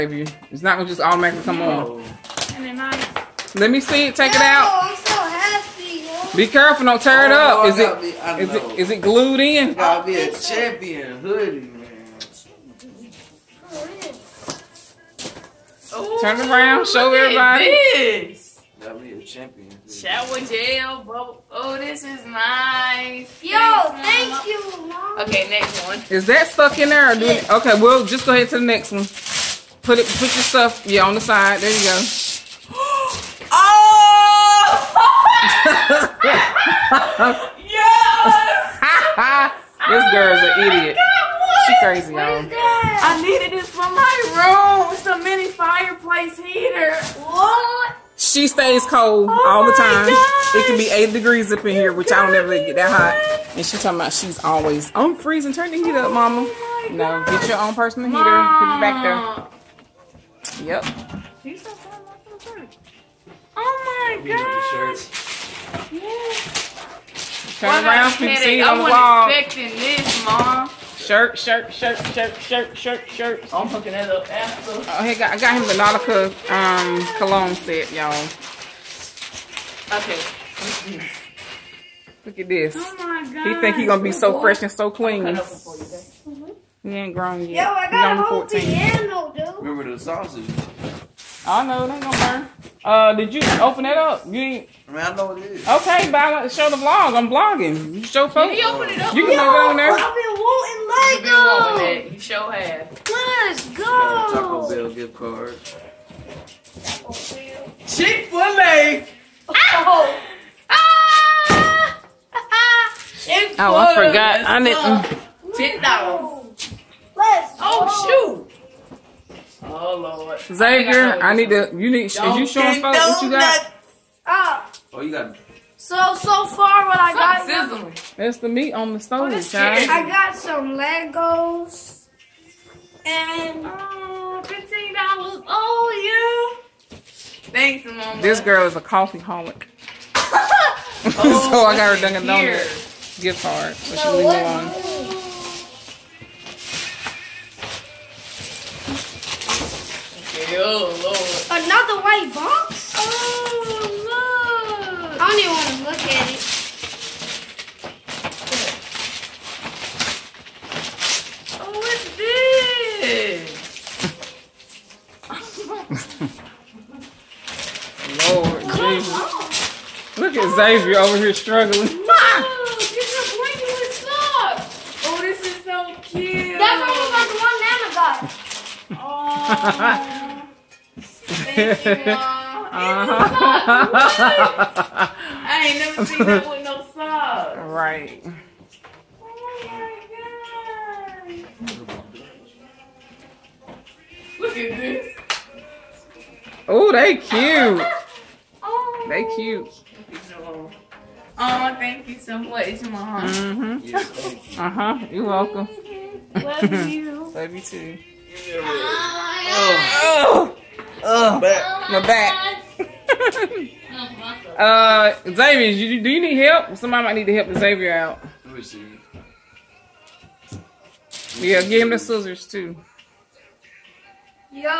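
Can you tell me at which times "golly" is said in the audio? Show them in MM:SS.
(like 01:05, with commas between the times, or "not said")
not said.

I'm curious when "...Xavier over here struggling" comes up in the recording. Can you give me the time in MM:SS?
02:50.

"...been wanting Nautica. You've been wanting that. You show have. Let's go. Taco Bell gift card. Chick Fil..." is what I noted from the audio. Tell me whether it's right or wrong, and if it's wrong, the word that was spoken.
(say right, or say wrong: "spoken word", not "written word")
wrong: "Lego", not "Nautica".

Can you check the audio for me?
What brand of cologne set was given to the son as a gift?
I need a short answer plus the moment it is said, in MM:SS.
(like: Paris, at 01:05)
Nautica, at 01:15.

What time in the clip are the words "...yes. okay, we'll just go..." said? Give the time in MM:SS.
00:27.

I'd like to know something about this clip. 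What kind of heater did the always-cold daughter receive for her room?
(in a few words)
Mini fireplace heater.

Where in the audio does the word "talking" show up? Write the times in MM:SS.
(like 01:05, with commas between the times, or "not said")
00:53.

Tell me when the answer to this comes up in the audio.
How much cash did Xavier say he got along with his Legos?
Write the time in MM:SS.
02:14.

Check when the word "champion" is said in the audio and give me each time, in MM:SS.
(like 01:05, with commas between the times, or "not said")
00:10, 00:19.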